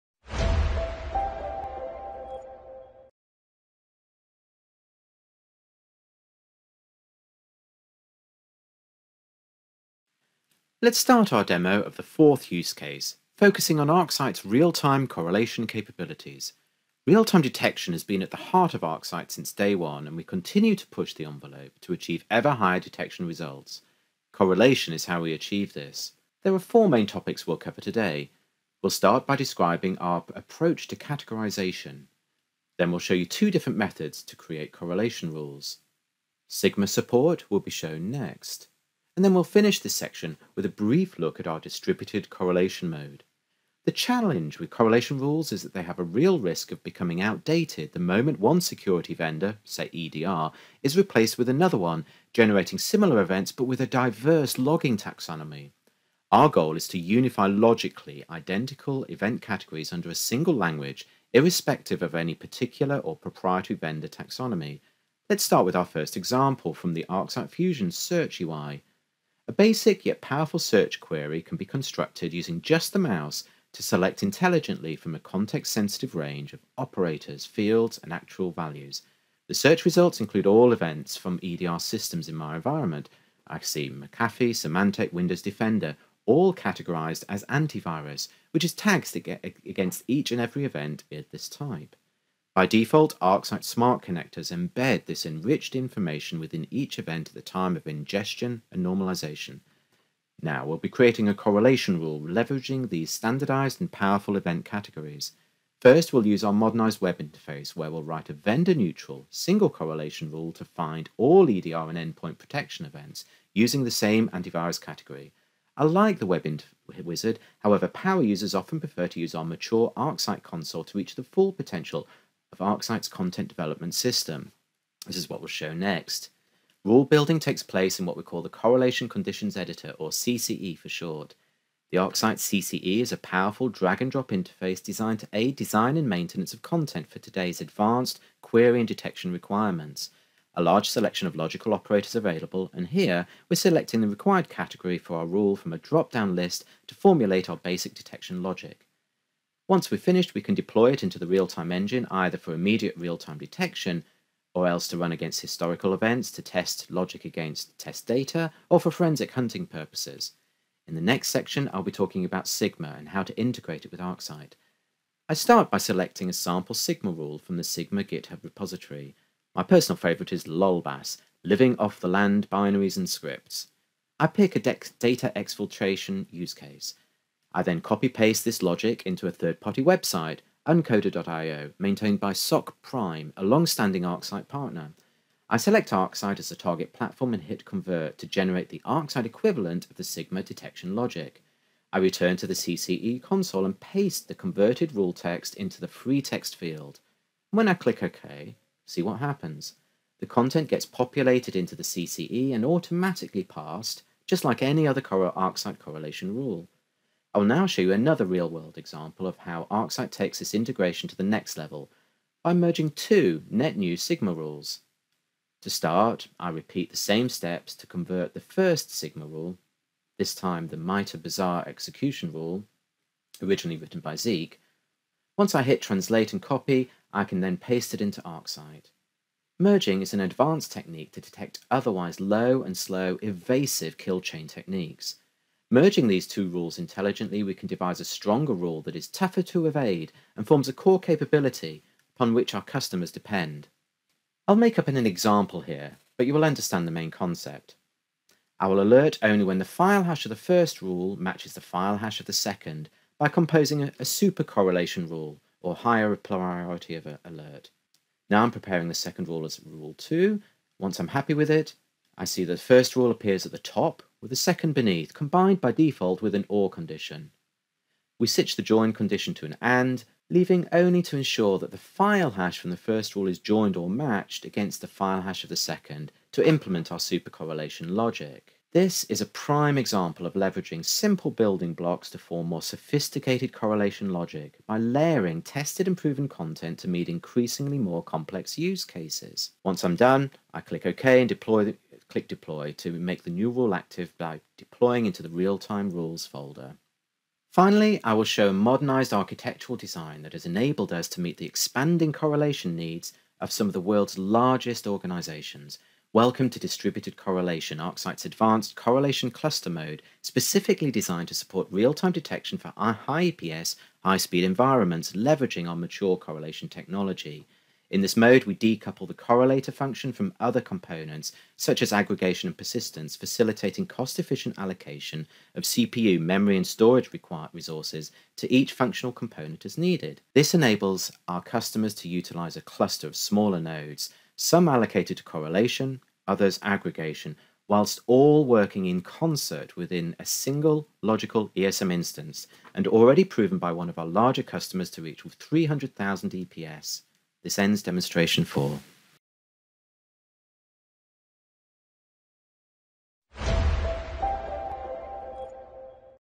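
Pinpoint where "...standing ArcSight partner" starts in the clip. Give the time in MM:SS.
03:03.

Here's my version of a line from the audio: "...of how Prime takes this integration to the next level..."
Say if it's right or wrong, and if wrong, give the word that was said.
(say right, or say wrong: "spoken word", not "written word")
wrong: "ArcSight", not "Prime".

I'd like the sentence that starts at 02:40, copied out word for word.
In the next section, I'll be talking about Sigma and how to integrate it with ArcSight.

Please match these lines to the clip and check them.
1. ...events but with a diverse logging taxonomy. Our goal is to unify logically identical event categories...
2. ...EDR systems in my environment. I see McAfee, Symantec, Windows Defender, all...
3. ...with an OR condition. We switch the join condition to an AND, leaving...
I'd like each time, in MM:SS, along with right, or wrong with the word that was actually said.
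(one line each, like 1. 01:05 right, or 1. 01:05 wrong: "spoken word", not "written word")
1. 00:53 right
2. 01:21 right
3. 04:26 right.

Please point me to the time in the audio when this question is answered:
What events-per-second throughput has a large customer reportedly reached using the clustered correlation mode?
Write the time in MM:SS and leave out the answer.
05:45.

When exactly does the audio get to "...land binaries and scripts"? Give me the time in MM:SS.
02:52.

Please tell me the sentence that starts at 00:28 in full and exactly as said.
We'll start by describing our approach to categorization.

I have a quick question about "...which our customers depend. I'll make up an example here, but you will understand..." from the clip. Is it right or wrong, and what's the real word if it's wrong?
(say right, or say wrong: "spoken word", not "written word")
right.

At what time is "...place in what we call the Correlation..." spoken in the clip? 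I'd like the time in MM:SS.
02:07.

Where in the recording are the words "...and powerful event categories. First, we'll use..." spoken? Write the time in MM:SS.
01:43.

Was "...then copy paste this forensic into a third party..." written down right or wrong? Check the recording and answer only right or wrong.
wrong.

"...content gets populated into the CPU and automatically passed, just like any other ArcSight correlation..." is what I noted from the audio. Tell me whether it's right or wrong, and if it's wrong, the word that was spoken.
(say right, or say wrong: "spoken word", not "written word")
wrong: "CCE", not "CPU".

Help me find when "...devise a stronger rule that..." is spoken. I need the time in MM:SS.
03:57.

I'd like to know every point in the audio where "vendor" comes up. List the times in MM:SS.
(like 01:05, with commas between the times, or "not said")
00:49, 01:03, 01:48.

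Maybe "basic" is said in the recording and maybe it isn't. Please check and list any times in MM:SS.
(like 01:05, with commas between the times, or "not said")
01:09, 02:27.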